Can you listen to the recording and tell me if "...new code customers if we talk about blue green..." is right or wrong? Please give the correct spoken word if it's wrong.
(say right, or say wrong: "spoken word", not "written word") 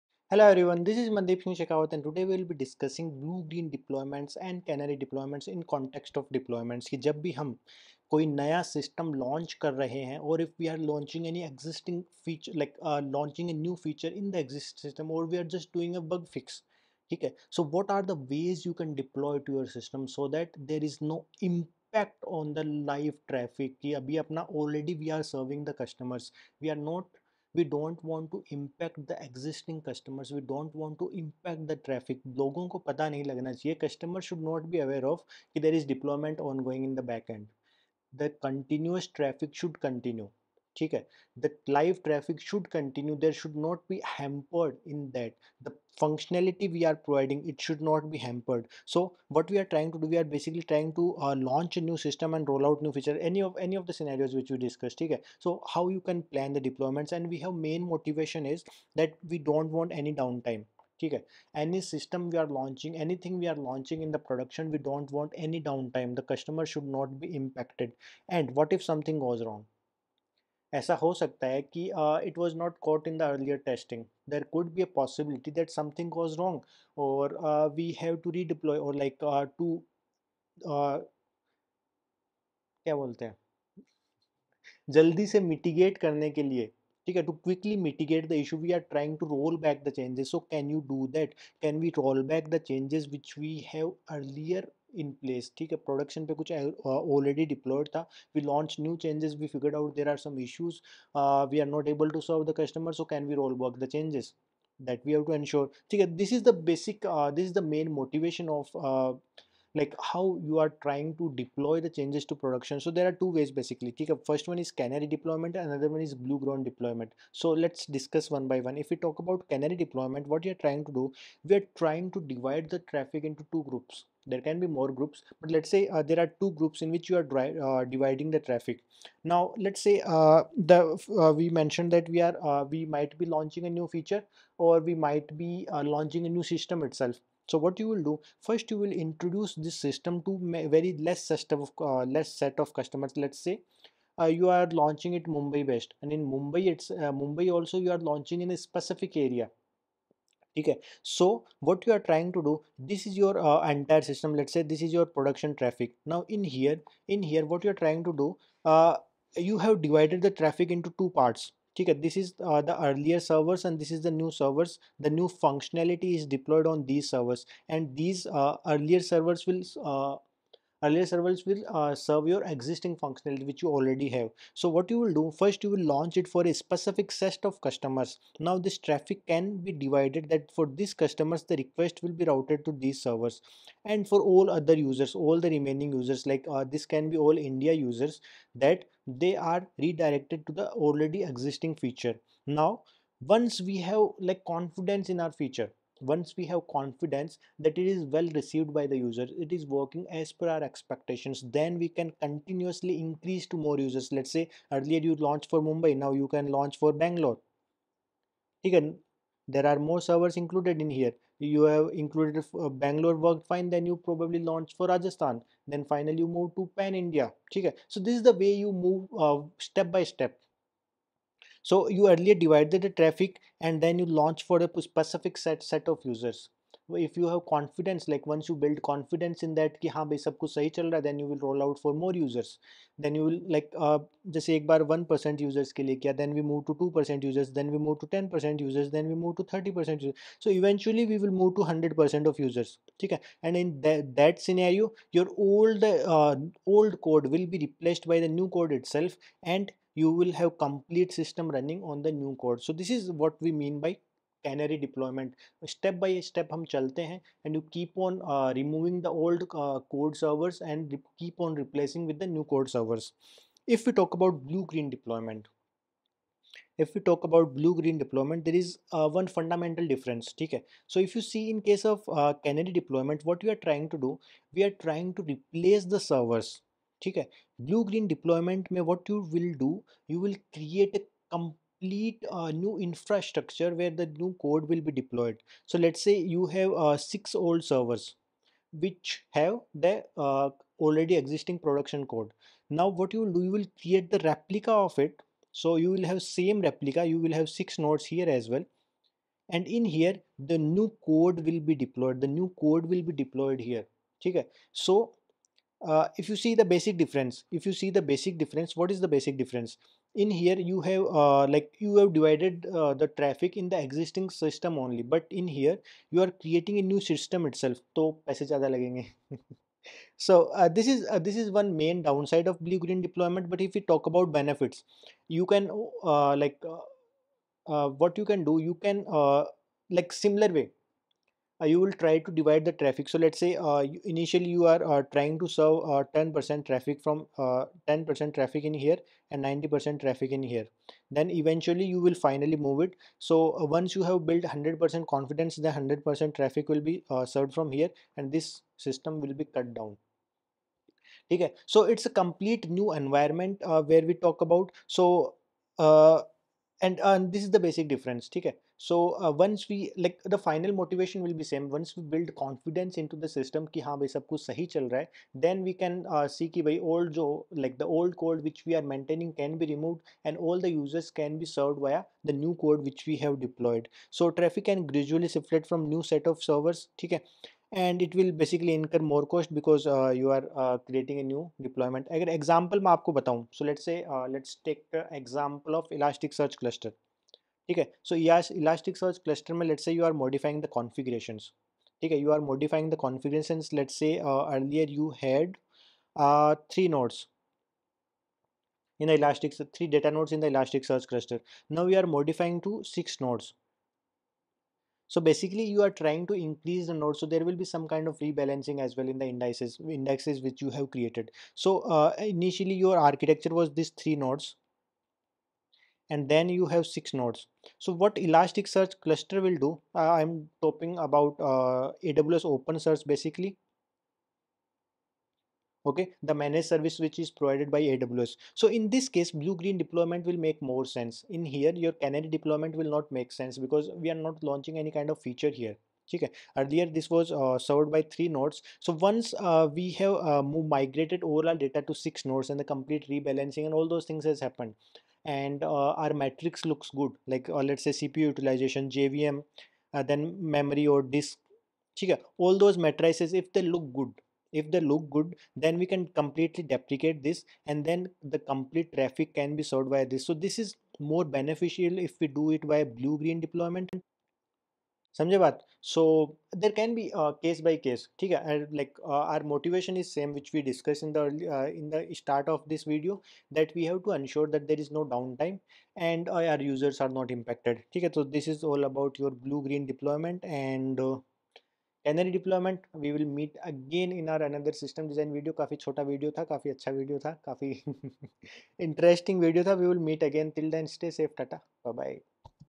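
wrong: "servers", not "customers".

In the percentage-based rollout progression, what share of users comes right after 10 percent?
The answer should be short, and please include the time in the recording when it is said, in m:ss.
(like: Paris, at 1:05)
30%, at 3:59.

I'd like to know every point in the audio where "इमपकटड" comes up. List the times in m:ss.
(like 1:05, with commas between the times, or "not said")
1:07.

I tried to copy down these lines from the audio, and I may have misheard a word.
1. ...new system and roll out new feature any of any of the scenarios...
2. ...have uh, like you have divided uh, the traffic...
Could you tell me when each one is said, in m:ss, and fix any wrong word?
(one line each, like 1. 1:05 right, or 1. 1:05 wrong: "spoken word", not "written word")
1. 0:51 right
2. 5:10 right.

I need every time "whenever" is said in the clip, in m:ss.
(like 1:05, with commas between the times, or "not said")
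not said.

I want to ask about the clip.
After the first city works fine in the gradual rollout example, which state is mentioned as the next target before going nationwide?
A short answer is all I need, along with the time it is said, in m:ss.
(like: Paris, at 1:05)
Rajasthan, at 3:34.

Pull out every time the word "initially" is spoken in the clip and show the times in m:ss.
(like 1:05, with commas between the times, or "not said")
5:34, 6:52.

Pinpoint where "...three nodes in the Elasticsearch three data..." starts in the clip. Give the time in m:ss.
6:36.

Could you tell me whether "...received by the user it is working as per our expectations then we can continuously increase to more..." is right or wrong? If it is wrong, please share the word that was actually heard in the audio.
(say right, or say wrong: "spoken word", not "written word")
right.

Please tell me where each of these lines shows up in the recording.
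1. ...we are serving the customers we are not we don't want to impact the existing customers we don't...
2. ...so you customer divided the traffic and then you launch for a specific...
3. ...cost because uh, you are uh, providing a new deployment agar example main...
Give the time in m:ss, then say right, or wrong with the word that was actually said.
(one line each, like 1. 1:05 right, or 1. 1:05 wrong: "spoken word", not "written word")
1. 0:24 right
2. 3:41 wrong: "earlier", not "customer"
3. 6:19 wrong: "creating", not "providing".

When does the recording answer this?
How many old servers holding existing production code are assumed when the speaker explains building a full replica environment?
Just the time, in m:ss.
4:46.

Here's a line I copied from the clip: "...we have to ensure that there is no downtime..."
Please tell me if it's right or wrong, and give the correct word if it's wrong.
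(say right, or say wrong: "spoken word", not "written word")
right.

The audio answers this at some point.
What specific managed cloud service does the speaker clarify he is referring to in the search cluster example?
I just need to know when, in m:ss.
7:02.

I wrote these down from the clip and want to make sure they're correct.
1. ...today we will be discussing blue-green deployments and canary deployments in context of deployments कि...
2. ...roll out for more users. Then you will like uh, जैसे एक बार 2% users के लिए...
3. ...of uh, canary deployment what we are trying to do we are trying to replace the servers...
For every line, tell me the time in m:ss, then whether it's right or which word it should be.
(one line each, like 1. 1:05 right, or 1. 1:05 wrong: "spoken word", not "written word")
1. 0:02 right
2. 3:51 wrong: "1", not "2"
3. 4:31 right.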